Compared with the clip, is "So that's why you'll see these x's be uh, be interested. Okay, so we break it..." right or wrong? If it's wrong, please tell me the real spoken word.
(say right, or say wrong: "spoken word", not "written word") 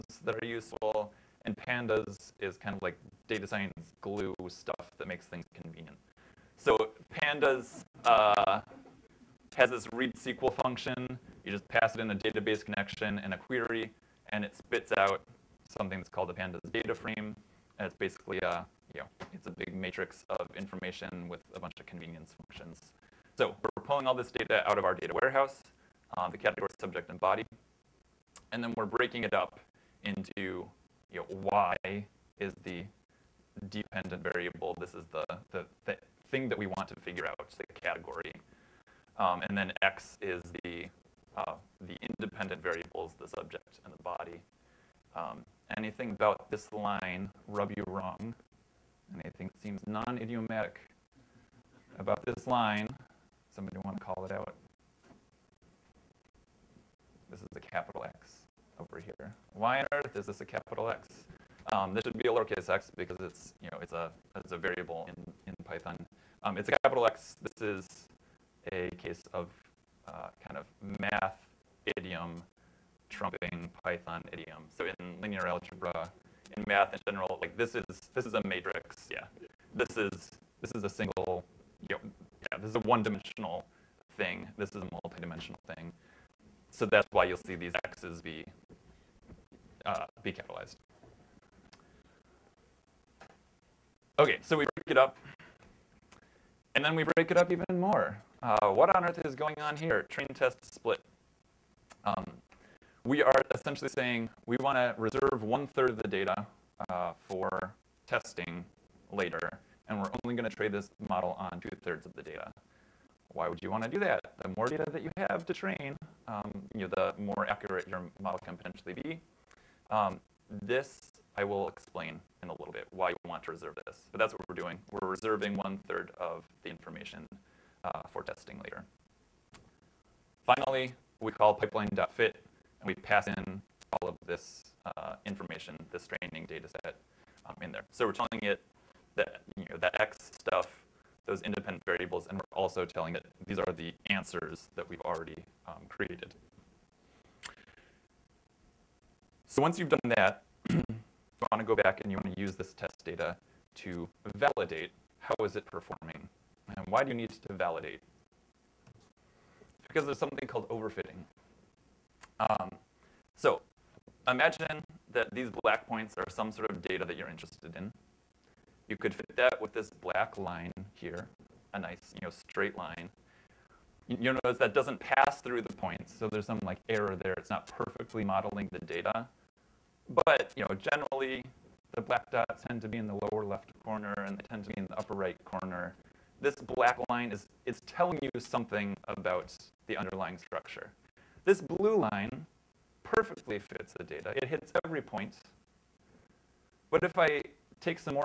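wrong: "capitalized", not "interested".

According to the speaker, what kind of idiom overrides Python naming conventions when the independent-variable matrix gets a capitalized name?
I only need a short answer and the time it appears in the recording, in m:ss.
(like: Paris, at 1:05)
math idiom, at 1:10.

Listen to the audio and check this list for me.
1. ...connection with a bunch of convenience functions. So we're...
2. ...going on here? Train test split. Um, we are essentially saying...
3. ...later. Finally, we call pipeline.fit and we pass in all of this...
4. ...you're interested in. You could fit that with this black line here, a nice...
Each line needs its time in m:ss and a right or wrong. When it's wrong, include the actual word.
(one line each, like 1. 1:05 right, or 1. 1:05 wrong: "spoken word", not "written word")
1. 0:20 wrong: "information", not "connection"
2. 1:39 right
3. 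2:08 right
4. 2:47 right.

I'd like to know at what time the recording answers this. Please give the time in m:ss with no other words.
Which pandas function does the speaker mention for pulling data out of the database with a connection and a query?
0:09.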